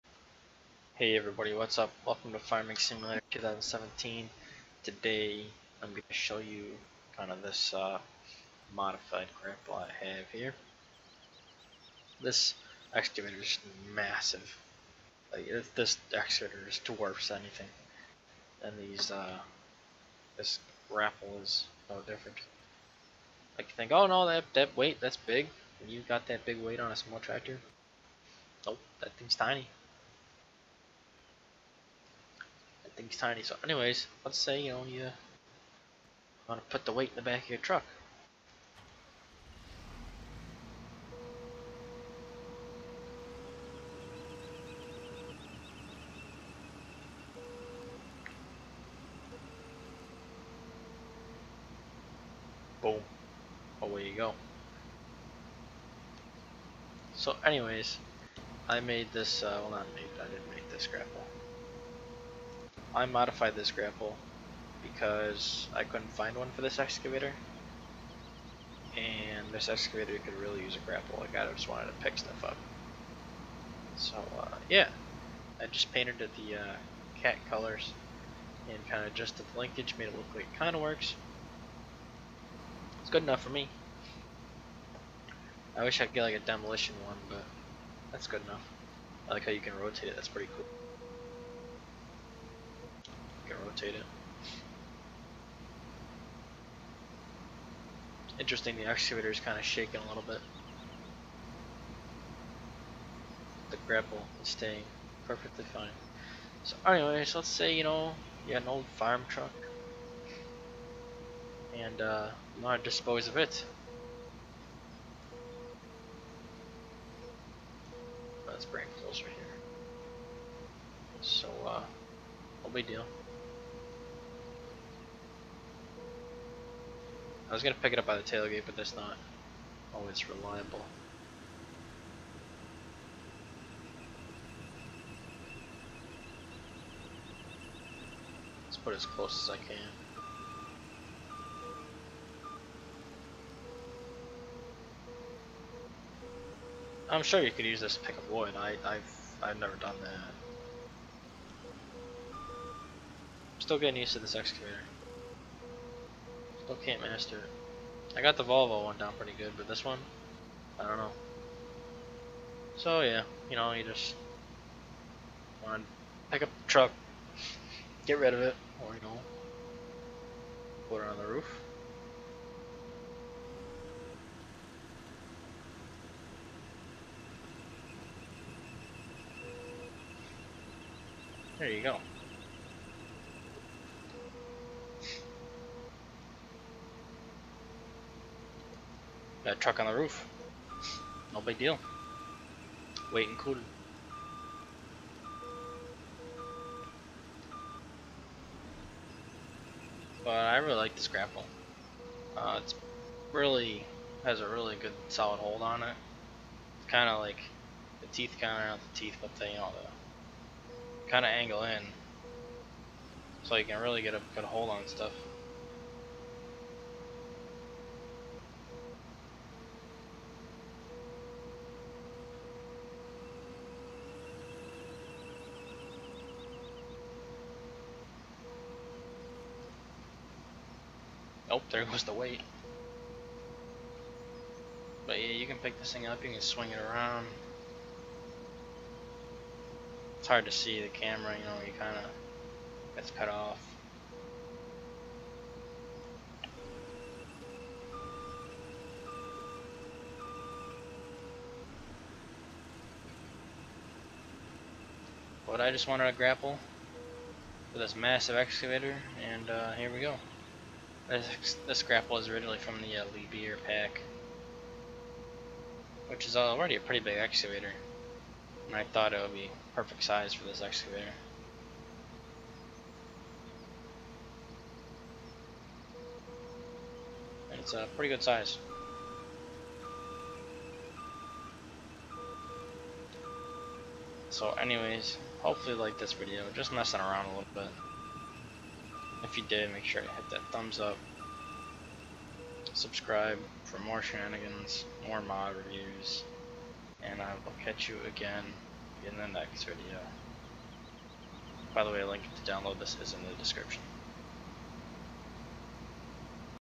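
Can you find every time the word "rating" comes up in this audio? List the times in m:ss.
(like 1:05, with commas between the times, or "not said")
not said.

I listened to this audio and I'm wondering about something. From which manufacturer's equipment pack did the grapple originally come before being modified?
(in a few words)
Liebherr.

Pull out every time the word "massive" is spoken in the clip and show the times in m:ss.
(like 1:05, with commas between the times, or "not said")
0:13, 4:17.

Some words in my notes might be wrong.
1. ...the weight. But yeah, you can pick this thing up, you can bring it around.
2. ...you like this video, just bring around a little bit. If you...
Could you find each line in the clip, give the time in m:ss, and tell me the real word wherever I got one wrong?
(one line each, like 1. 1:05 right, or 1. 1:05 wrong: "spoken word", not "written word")
1. 3:52 wrong: "swing", not "bring"
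2. 4:45 wrong: "messing", not "bring".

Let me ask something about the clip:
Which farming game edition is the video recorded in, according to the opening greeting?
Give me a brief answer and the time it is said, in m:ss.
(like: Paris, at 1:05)
Farming Simulator 2017, at 0:02.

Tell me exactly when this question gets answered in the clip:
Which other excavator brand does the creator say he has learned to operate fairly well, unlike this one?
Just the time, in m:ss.
2:38.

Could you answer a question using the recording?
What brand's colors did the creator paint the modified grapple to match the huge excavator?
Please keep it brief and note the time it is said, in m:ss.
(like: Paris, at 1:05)
Cat, at 1:17.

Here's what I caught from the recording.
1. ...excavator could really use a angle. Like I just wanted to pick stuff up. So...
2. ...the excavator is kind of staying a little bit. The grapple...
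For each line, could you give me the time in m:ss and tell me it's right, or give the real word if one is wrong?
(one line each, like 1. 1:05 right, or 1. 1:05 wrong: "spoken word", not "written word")
1. 1:09 wrong: "grapple", not "angle"
2. 1:38 wrong: "shaking", not "staying".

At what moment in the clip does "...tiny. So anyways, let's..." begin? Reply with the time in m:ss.
0:33.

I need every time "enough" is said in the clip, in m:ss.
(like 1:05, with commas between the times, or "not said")
1:23, 1:28.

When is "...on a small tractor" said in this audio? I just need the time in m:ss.
0:26.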